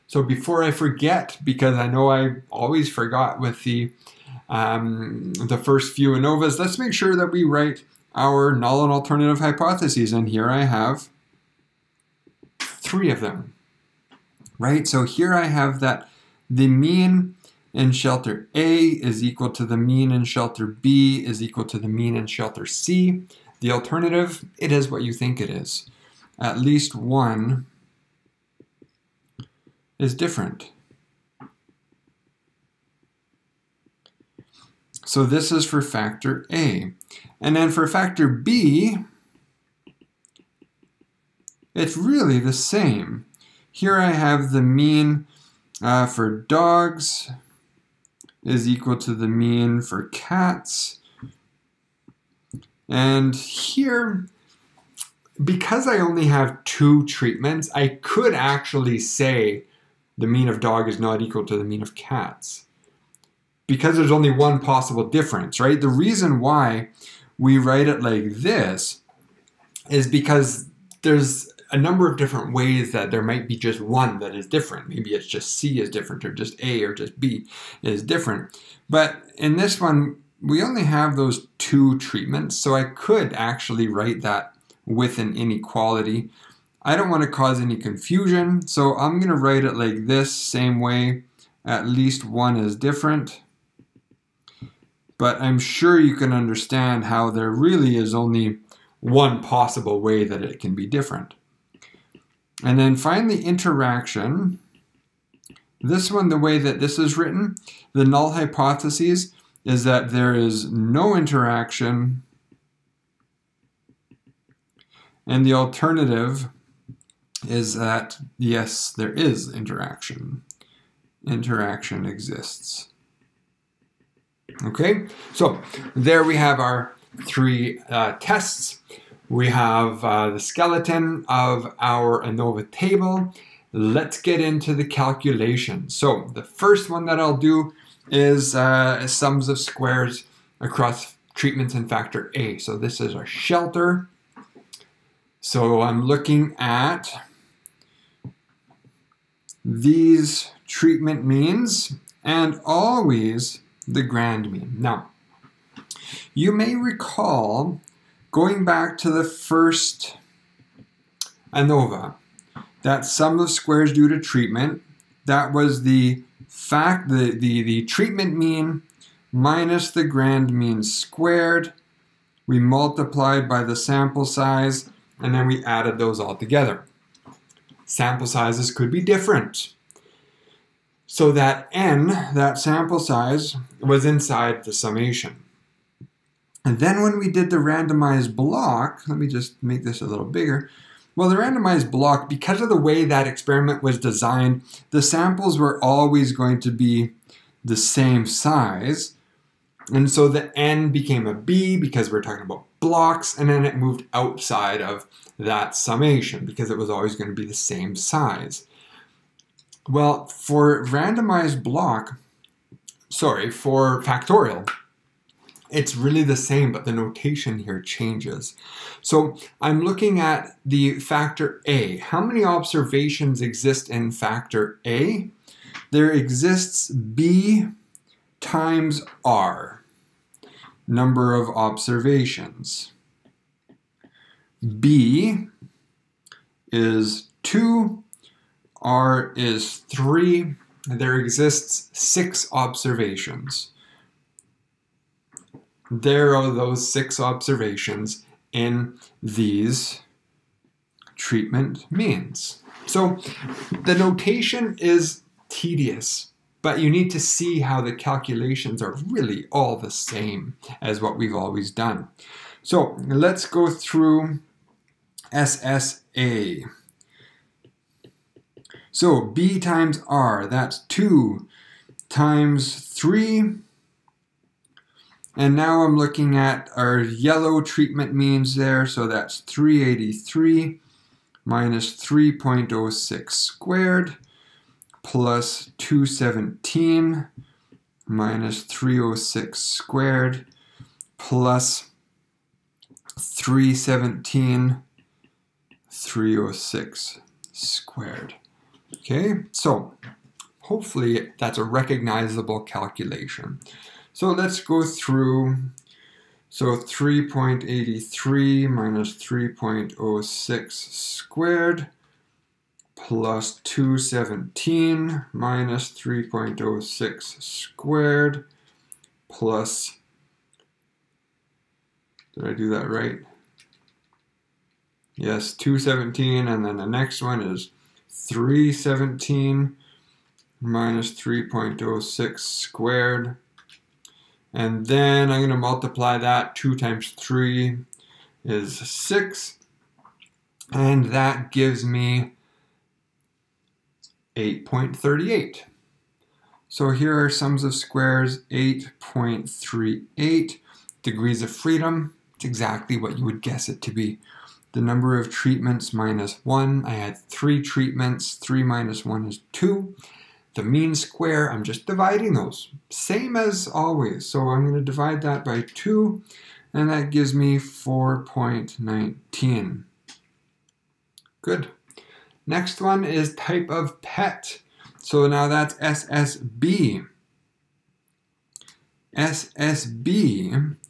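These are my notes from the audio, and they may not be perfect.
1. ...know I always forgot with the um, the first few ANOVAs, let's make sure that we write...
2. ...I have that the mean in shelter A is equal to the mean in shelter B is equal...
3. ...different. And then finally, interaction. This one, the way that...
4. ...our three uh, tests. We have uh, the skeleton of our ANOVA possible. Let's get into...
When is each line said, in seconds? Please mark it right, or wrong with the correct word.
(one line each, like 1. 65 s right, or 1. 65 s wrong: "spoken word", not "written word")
1. 1 s right
2. 15 s right
3. 100 s right
4. 126 s wrong: "table", not "possible".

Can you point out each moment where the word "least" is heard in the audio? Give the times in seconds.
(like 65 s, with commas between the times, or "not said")
26 s, 91 s.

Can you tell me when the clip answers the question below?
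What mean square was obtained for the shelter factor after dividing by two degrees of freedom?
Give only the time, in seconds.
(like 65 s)
367 s.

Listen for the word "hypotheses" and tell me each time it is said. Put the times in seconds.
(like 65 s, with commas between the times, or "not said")
9 s, 108 s.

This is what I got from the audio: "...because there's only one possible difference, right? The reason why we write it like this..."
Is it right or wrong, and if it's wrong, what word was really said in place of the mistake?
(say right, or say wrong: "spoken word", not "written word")
right.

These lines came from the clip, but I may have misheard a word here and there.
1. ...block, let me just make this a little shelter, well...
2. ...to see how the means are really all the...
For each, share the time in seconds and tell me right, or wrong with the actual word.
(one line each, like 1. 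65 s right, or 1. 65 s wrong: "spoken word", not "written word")
1. 188 s wrong: "bigger", not "shelter"
2. 257 s wrong: "calculations", not "means".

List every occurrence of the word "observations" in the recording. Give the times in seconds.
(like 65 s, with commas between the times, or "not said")
222 s, 231 s, 242 s, 247 s.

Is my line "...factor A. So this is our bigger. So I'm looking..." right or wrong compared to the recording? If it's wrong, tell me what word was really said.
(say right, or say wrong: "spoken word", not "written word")
wrong: "shelter", not "bigger".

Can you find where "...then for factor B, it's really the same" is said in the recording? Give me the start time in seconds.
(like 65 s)
37 s.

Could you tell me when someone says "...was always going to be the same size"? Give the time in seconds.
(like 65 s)
206 s.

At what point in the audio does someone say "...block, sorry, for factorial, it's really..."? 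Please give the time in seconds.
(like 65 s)
211 s.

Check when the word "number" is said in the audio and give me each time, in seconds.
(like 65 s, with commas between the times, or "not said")
71 s, 230 s, 354 s.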